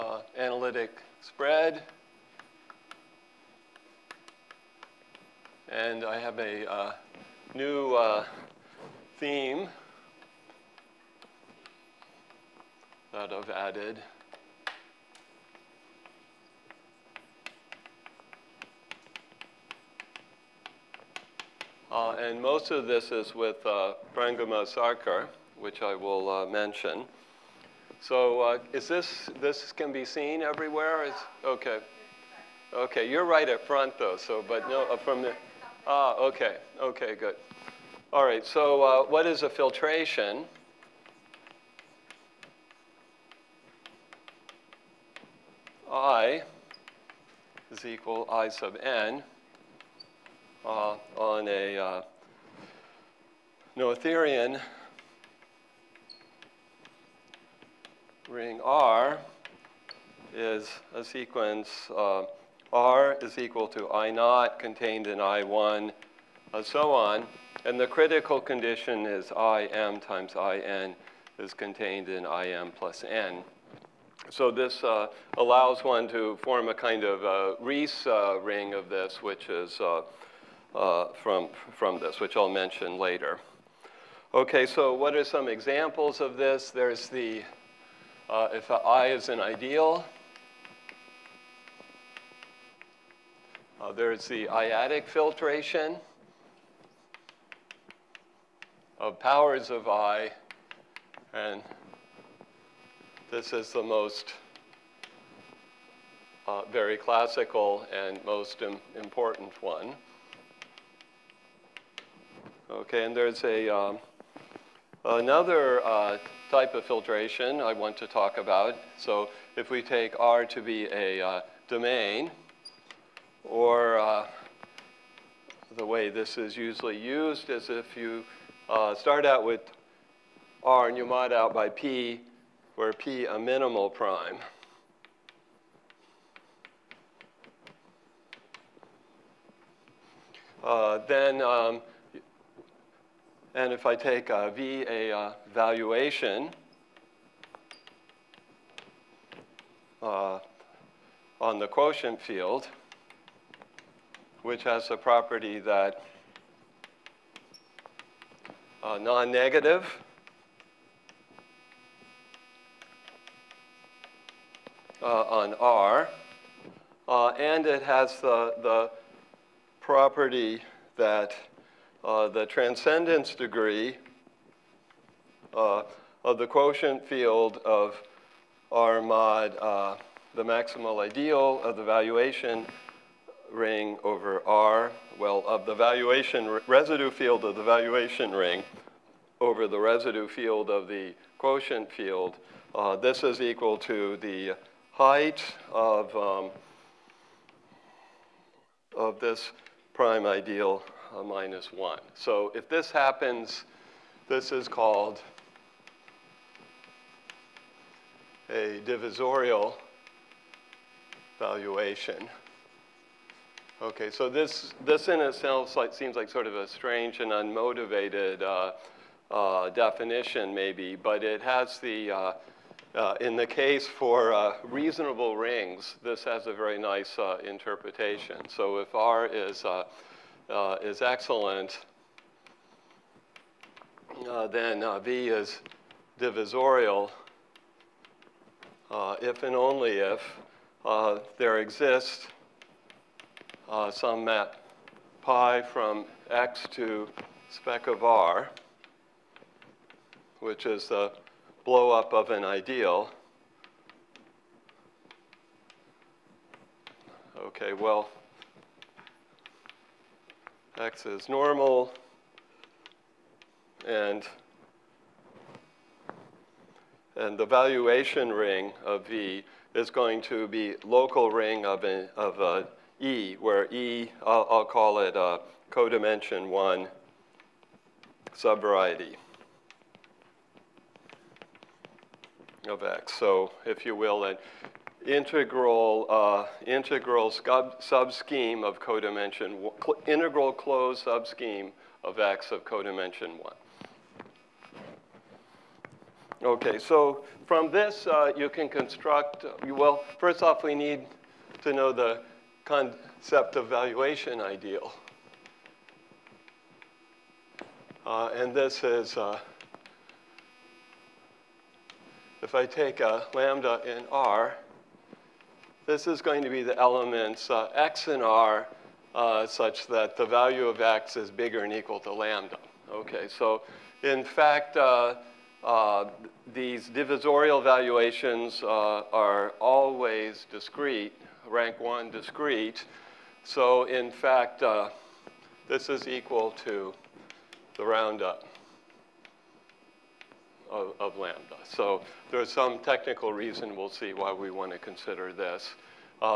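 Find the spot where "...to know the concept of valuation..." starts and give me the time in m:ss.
5:01.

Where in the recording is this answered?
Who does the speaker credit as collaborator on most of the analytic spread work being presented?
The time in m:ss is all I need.
0:24.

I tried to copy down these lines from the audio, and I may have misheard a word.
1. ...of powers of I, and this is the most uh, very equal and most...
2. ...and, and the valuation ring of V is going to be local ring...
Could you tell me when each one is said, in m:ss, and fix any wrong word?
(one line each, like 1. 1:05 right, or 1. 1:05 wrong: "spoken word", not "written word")
1. 1:38 wrong: "classical", not "equal"
2. 4:23 right.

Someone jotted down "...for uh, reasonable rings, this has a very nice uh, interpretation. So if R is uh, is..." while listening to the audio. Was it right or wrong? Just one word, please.
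right.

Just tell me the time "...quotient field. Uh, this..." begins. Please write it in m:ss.
3:11.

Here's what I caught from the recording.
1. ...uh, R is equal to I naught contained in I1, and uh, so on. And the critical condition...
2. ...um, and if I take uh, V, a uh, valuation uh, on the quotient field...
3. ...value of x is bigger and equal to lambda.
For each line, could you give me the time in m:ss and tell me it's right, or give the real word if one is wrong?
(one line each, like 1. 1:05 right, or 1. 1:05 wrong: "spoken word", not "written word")
1. 1:01 right
2. 2:21 right
3. 5:20 right.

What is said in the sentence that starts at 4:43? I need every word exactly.
So if you will, integral, uh, integral scheme of codimension, integral closed sub scheme of X of codimension 1.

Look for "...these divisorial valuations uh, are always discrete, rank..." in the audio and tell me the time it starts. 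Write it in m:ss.
5:26.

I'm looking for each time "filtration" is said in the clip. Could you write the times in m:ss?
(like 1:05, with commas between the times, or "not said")
0:39, 1:35, 1:56.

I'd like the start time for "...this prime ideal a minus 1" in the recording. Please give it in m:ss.
3:19.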